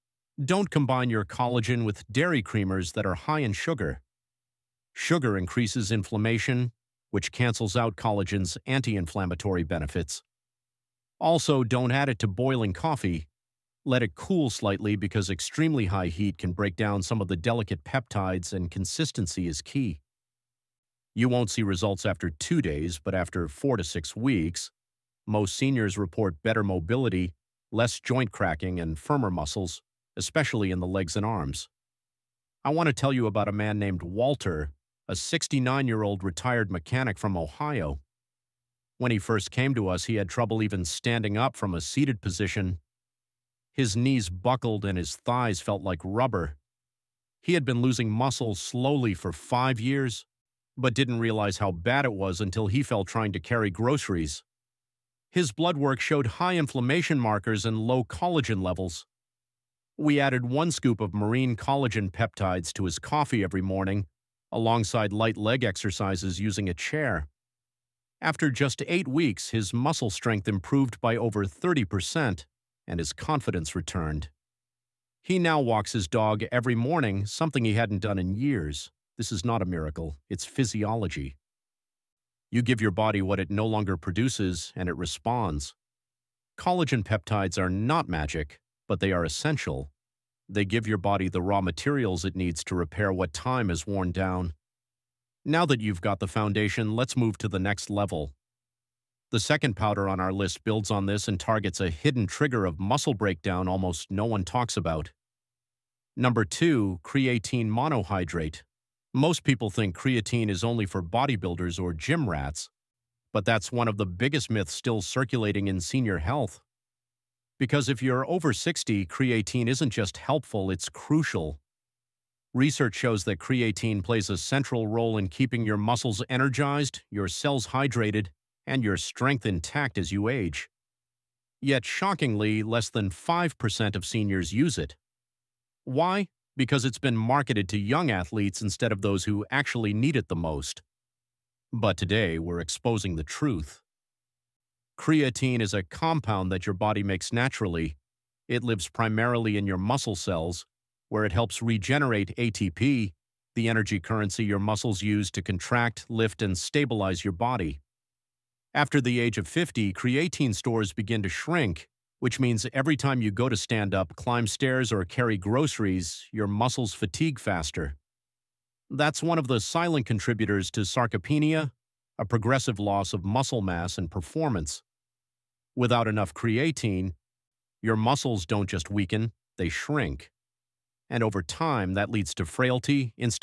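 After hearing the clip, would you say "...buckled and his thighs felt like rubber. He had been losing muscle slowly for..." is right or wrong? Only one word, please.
right.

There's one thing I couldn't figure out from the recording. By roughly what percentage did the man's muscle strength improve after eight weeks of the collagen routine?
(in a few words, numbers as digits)
over 30%.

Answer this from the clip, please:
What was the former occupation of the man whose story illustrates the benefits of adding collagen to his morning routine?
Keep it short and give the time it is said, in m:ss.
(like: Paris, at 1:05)
mechanic, at 0:36.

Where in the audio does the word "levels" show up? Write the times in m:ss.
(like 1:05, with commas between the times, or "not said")
0:58, 1:37.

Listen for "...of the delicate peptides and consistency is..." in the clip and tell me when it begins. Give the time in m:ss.
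0:17.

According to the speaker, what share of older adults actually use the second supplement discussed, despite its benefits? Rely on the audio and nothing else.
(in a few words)
less than 5%.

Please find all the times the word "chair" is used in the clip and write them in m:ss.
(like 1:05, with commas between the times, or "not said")
1:06.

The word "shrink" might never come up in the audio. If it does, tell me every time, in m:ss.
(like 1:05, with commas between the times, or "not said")
2:41, 2:59.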